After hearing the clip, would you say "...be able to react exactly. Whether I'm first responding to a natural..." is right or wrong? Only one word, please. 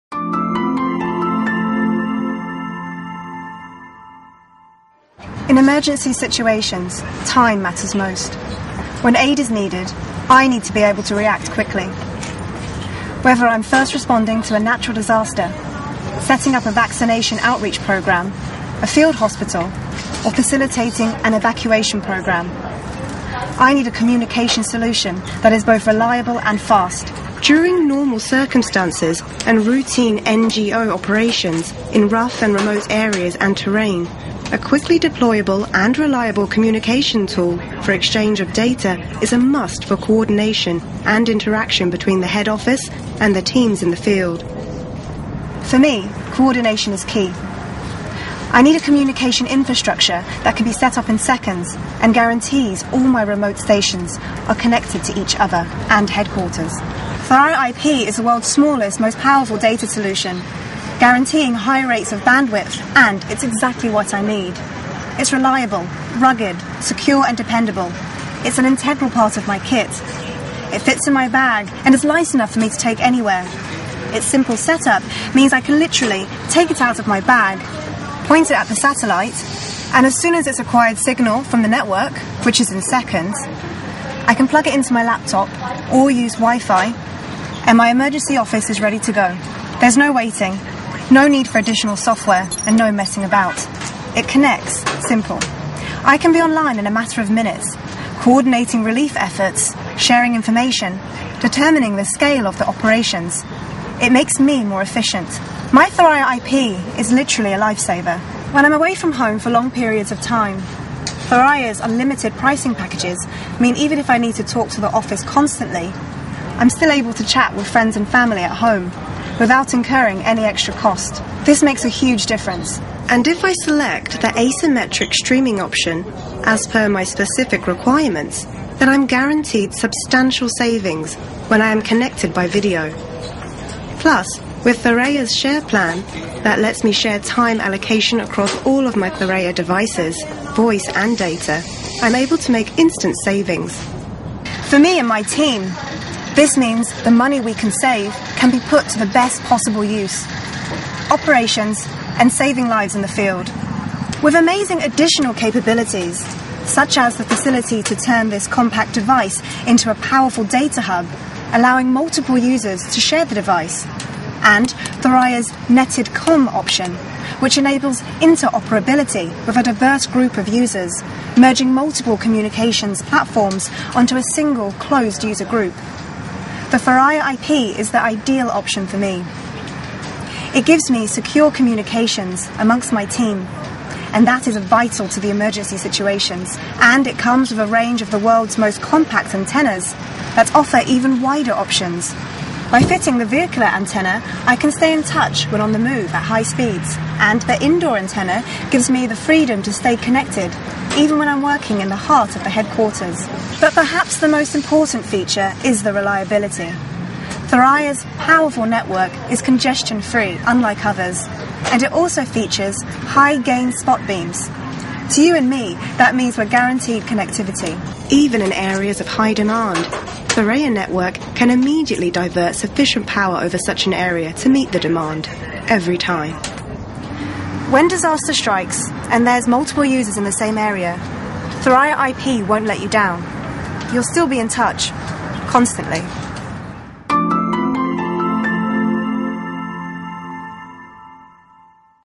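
wrong.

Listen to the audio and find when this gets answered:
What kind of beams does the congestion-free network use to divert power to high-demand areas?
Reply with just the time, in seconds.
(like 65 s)
212 s.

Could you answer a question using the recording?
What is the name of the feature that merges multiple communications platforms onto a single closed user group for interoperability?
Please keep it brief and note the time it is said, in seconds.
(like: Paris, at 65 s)
netted COM, at 165 s.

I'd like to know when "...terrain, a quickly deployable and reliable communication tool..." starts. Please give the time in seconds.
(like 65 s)
33 s.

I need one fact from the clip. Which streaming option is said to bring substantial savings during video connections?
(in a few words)
asymmetric streaming.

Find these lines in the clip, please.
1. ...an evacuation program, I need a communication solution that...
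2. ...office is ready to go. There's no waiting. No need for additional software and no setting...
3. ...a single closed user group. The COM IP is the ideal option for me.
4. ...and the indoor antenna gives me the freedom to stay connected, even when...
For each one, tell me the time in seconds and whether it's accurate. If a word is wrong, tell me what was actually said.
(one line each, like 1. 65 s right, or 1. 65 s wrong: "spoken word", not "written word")
1. 21 s right
2. 88 s wrong: "messing", not "setting"
3. 174 s wrong: "Thuraya", not "COM"
4. 197 s right.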